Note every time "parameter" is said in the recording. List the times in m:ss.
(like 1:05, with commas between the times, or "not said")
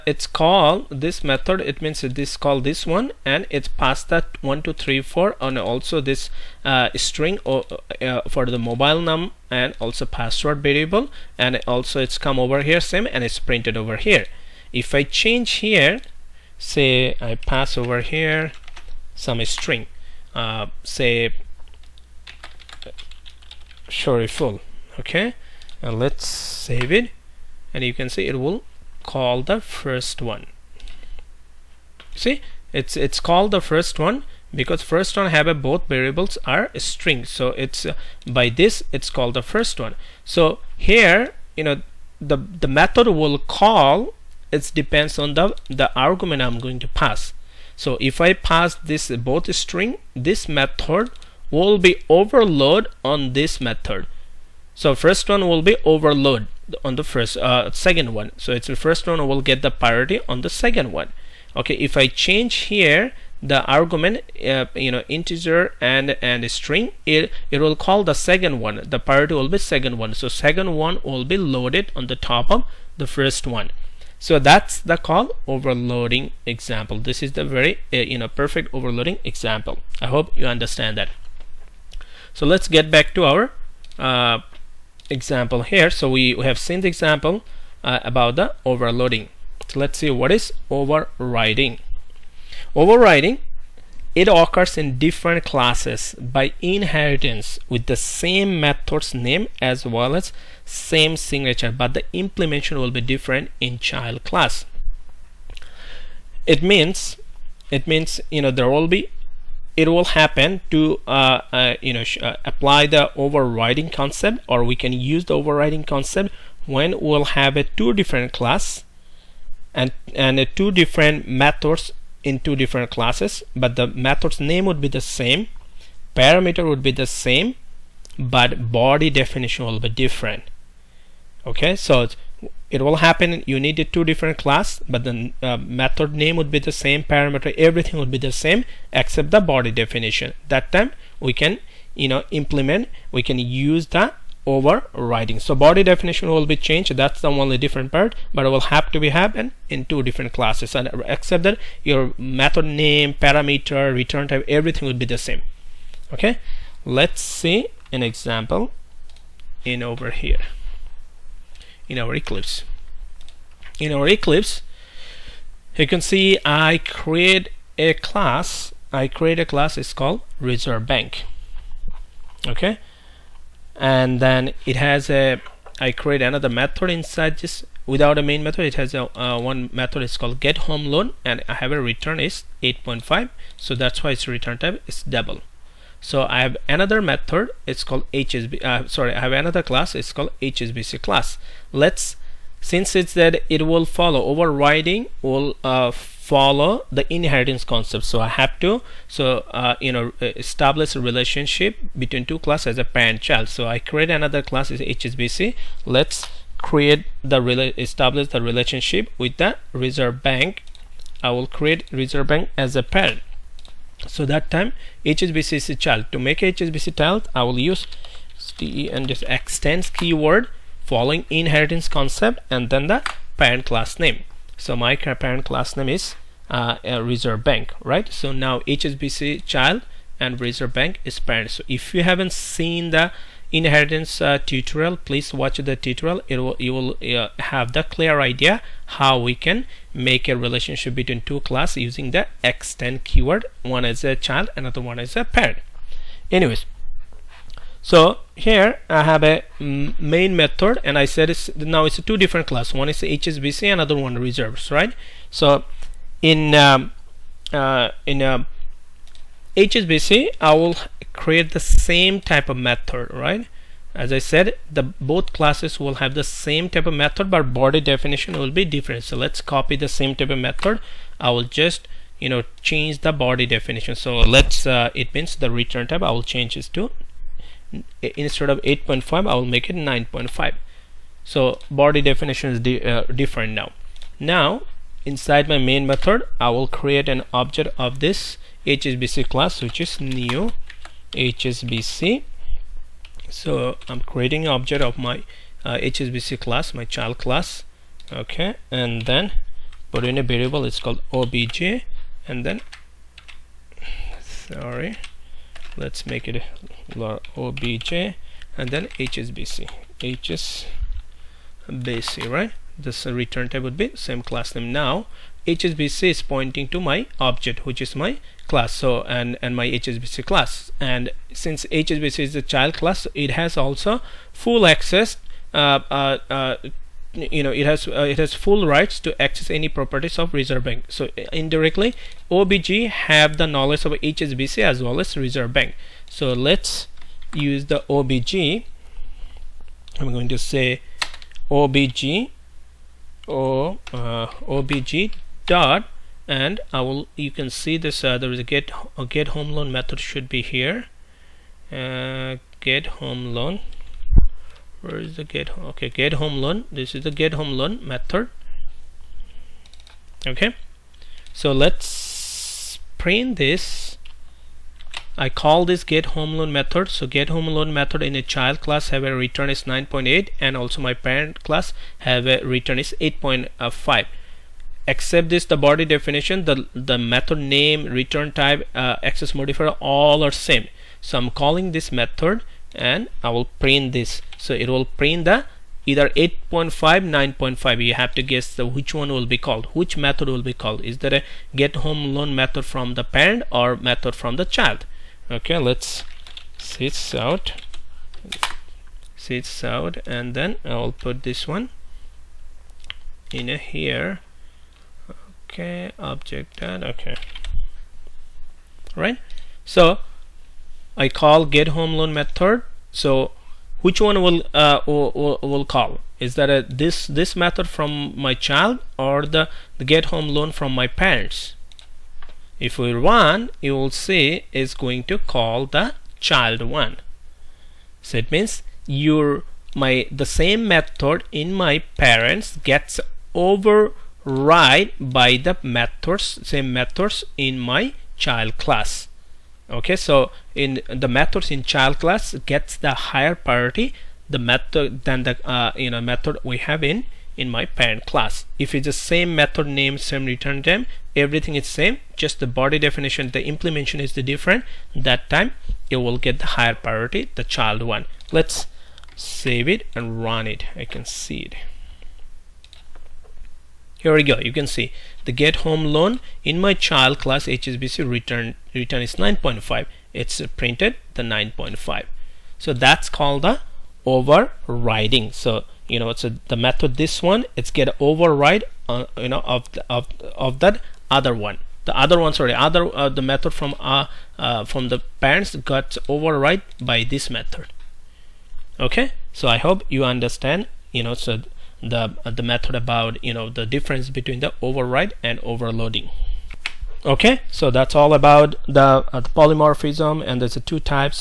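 2:06, 2:17, 2:33.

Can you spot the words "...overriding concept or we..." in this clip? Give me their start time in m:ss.
1:53.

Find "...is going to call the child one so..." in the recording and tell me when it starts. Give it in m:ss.
7:04.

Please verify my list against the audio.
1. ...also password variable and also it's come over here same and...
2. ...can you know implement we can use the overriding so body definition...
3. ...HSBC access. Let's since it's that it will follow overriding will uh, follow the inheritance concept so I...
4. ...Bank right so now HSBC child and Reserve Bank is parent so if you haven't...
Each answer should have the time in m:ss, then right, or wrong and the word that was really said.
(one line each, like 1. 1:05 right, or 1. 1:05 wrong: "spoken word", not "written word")
1. 0:09 right
2. 2:21 right
3. 3:10 wrong: "class", not "access"
4. 3:47 right.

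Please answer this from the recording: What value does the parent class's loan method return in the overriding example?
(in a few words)
8.5.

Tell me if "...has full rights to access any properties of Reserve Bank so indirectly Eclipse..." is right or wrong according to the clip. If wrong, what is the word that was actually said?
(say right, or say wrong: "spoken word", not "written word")
wrong: "OBJ", not "Eclipse".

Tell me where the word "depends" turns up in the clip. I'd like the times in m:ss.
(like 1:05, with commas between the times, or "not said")
0:44.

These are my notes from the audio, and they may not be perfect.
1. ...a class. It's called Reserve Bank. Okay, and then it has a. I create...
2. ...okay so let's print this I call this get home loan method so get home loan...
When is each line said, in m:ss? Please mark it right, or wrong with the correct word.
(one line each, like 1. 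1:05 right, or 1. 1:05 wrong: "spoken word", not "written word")
1. 2:49 right
2. 6:00 right.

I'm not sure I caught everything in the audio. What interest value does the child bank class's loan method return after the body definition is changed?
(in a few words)
9.5.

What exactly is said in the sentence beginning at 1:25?
So we, we have seen the example uh, about the overloading.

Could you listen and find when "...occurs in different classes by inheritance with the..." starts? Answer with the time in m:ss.
1:34.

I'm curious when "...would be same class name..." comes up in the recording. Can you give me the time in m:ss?
5:13.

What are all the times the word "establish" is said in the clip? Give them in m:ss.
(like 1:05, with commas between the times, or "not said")
3:20, 3:27.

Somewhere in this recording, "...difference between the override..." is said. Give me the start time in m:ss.
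8:13.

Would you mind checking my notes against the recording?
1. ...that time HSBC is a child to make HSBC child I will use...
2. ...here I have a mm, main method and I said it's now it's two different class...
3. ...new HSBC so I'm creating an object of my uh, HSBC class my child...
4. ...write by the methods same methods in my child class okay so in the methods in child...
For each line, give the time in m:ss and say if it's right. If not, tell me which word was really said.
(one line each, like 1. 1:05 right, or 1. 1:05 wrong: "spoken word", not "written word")
1. 3:34 right
2. 4:08 right
3. 4:49 right
4. 7:14 right.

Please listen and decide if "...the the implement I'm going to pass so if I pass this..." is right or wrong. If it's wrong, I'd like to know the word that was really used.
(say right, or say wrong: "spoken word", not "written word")
wrong: "argument", not "implement".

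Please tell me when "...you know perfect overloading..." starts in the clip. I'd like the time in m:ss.
1:17.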